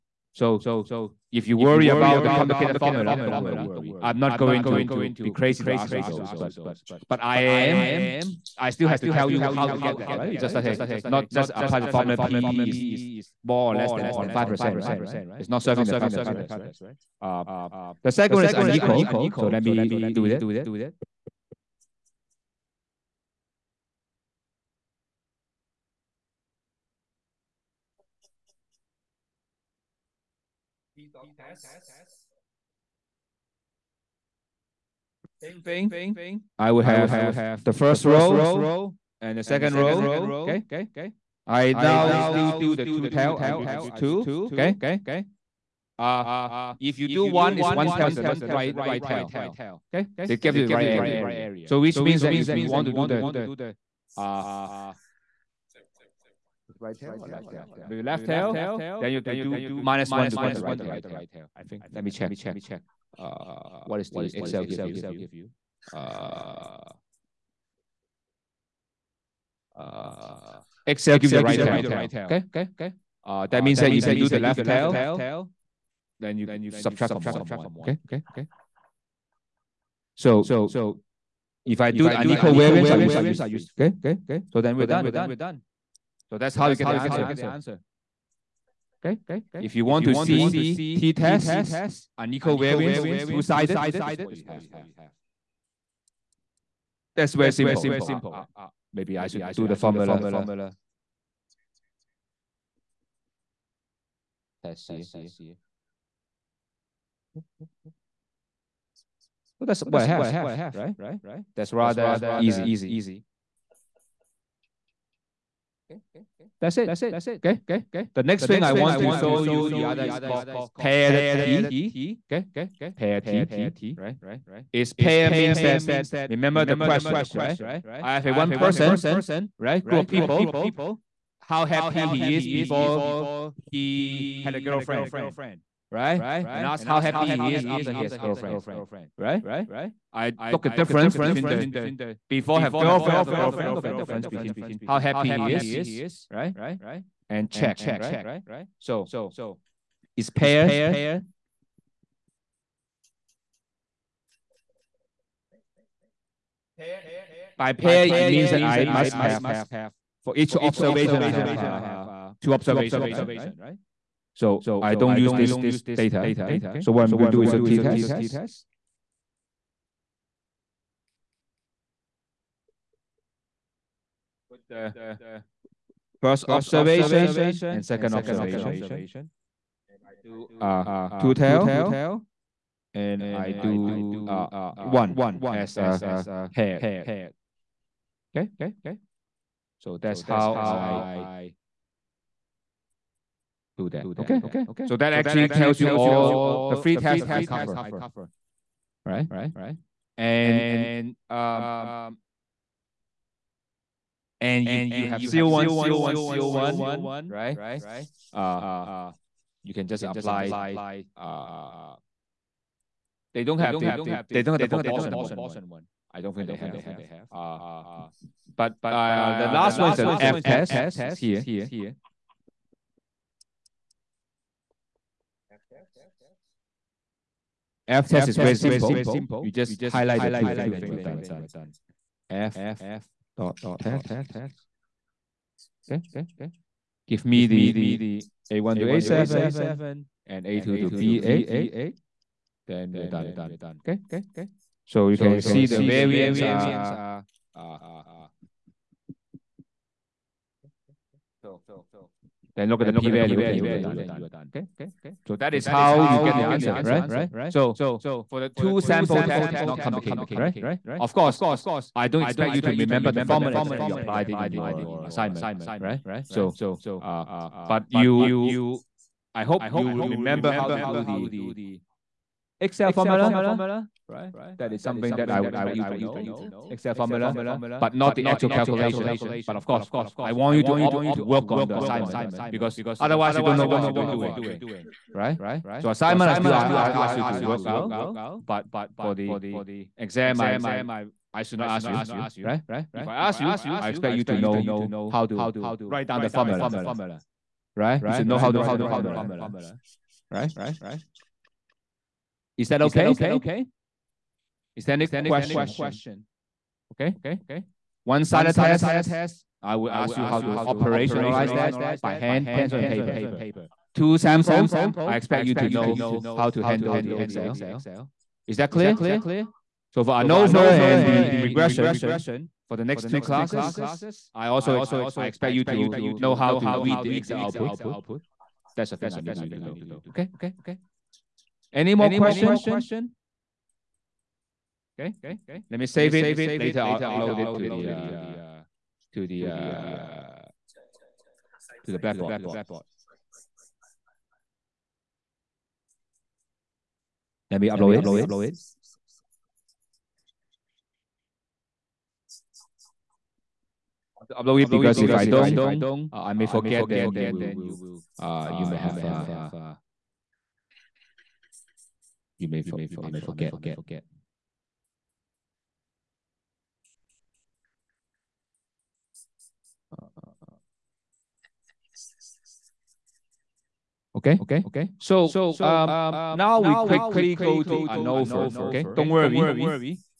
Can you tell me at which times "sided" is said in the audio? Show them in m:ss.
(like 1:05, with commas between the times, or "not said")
1:33, 5:08.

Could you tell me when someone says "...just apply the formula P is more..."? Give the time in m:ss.
0:11.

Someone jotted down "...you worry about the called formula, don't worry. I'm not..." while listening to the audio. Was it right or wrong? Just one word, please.
wrong.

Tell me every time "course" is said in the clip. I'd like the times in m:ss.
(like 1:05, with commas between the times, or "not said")
4:21, 4:39.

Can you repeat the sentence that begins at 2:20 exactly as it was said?
I look at difference between the before have girlfriend after girlfriend, look at the difference between how happy he is, right?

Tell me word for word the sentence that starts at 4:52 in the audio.
If I ask you, I expect you to know how to write down the formula, right?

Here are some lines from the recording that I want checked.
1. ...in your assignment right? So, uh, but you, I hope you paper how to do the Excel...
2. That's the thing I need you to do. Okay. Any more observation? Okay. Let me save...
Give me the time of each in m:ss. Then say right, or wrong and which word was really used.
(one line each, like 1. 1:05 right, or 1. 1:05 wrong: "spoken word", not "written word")
1. 4:24 wrong: "remember", not "paper"
2. 5:28 wrong: "question", not "observation".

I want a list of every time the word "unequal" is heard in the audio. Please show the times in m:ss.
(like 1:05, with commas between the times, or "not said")
0:18, 1:22, 1:32.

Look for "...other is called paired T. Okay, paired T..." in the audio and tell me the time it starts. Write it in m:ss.
1:59.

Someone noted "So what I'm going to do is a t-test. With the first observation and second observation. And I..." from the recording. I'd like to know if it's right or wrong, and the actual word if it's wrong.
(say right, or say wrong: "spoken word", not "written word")
right.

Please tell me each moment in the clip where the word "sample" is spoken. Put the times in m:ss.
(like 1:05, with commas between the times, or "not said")
4:18, 5:14.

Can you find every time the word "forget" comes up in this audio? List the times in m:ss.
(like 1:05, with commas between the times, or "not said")
5:56, 6:03.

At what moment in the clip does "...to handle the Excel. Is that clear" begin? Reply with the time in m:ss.
5:16.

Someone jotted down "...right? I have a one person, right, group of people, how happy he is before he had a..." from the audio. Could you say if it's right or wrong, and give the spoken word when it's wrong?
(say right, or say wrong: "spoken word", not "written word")
right.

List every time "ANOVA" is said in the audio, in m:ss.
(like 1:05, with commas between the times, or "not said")
5:20, 6:17.